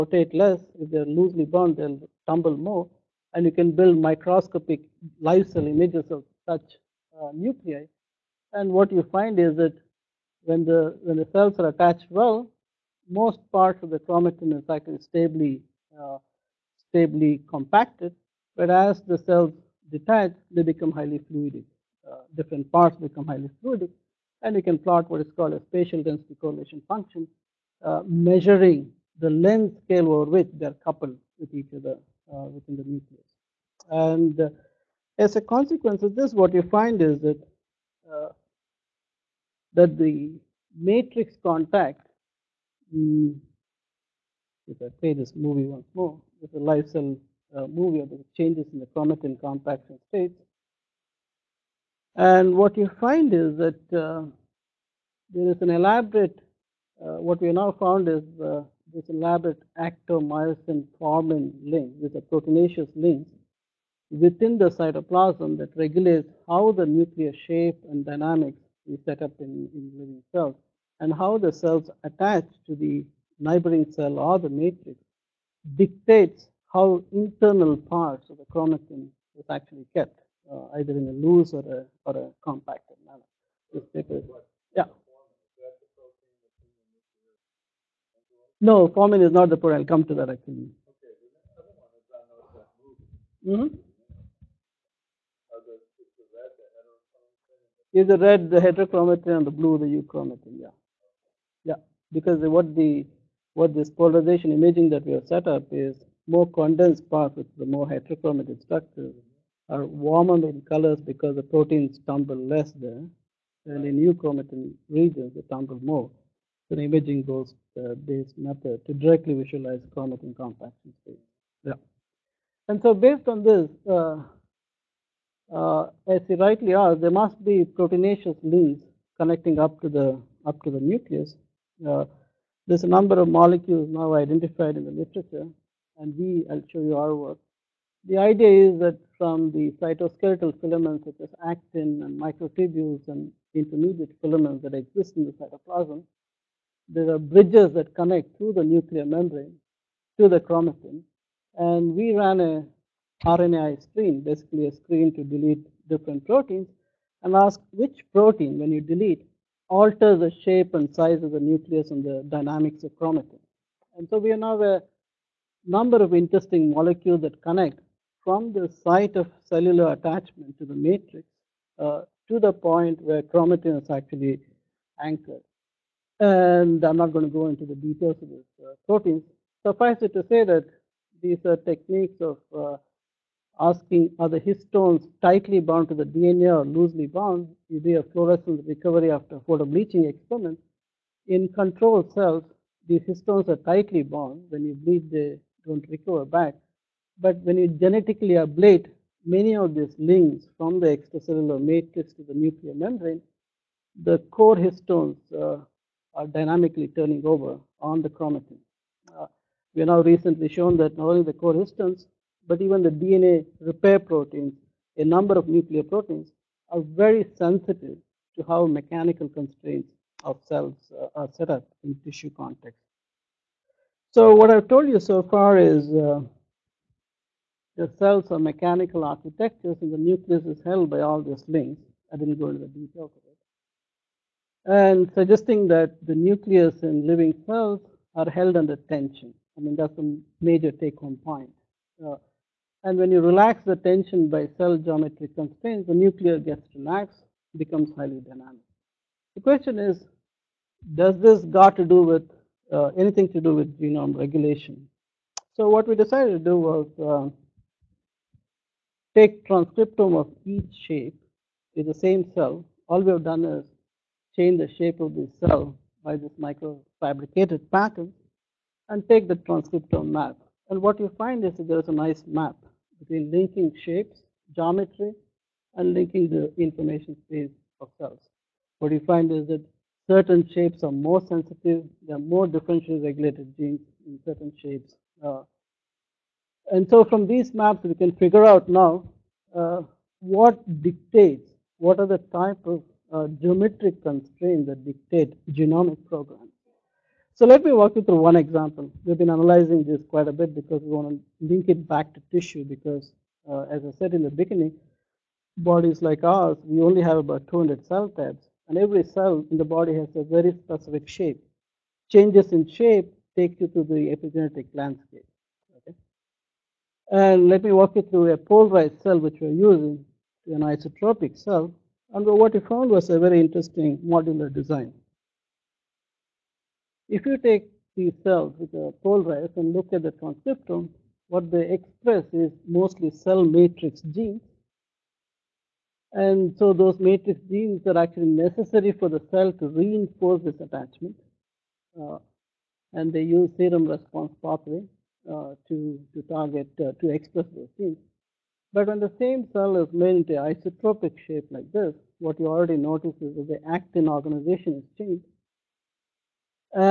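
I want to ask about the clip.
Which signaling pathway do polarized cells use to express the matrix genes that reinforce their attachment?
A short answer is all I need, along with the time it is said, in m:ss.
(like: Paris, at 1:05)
Serum response pathway, at 5:43.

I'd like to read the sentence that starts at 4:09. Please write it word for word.
The question is, does this got to do with uh, anything to do with genome regulation.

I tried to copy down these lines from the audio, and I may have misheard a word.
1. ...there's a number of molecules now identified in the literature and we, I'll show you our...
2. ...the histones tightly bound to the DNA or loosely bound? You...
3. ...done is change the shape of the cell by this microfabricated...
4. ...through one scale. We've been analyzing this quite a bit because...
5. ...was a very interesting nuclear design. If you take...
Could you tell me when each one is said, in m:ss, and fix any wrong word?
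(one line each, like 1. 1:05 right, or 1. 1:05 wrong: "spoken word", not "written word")
1. 2:12 right
2. 3:04 right
3. 4:23 right
4. 4:58 wrong: "example", not "scale"
5. 5:22 wrong: "modular", not "nuclear".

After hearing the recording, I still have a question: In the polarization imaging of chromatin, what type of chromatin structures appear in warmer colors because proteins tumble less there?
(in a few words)
Heterochromatic structures.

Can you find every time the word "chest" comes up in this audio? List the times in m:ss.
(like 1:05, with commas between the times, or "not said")
not said.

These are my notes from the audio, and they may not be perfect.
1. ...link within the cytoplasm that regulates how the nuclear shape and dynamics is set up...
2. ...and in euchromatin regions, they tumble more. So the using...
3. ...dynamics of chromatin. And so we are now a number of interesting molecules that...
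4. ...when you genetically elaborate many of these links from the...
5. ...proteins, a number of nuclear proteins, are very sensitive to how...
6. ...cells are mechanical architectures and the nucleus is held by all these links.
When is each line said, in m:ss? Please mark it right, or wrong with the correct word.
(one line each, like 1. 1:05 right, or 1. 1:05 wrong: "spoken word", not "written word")
1. 1:02 right
2. 1:53 wrong: "imaging", not "using"
3. 2:42 right
4. 3:17 wrong: "ablate", not "elaborate"
5. 3:33 right
6. 3:47 right.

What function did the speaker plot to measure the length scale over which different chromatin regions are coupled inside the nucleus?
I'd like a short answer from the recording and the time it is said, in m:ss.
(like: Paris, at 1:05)
Spatial density correlation function, at 0:25.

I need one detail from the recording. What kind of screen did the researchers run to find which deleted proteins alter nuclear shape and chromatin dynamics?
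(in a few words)
RNAi screen.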